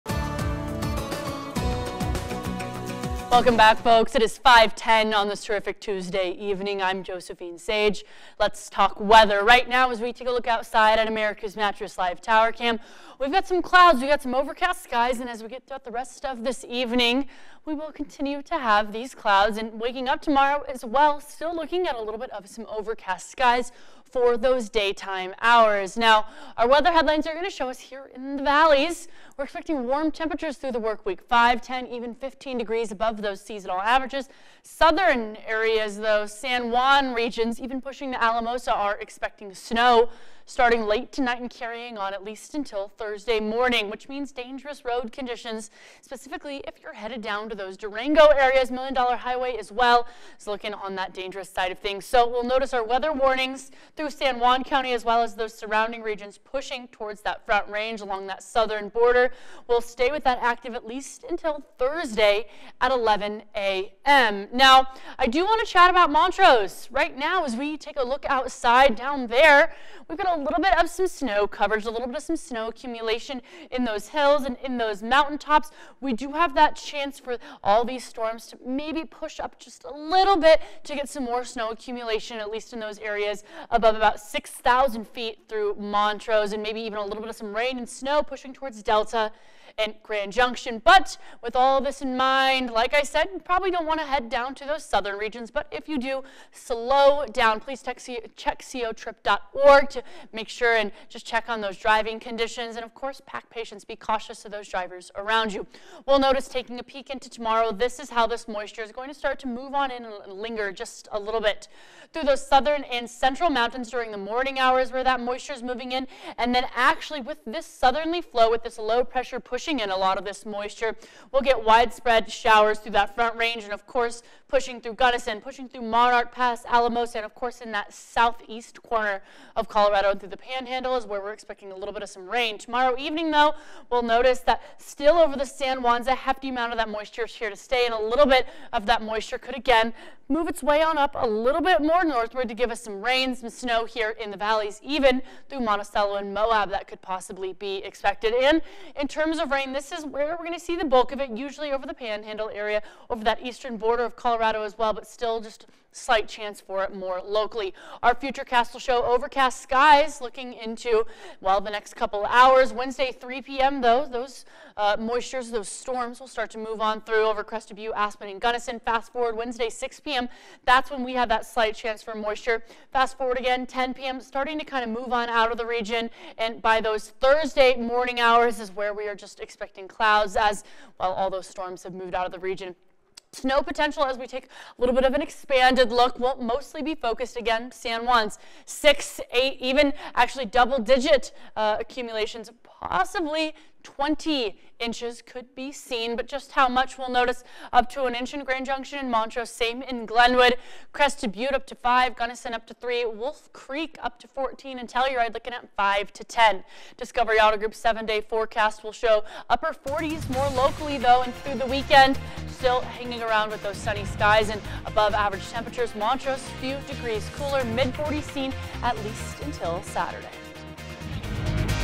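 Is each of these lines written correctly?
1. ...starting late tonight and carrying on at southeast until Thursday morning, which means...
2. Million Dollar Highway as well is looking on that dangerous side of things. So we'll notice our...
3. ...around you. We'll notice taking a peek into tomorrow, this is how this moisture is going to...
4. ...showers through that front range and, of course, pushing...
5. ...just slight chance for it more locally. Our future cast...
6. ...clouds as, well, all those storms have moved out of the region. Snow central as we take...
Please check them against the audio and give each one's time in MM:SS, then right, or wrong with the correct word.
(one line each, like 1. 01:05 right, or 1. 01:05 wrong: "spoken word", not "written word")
1. 00:40 wrong: "least", not "southeast"
2. 00:48 right
3. 01:45 right
4. 02:02 right
5. 02:35 right
6. 02:59 wrong: "potential", not "central".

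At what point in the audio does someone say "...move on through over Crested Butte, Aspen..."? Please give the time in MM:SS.
02:46.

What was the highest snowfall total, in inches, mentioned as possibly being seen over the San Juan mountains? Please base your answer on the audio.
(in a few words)
20 inches.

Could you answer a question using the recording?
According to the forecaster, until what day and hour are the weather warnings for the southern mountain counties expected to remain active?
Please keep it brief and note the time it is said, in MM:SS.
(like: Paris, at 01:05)
Thursday at 11 a.m., at 01:01.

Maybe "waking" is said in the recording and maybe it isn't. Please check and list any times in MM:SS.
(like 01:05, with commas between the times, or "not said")
00:19.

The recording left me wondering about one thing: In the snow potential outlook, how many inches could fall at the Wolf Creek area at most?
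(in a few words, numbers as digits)
14.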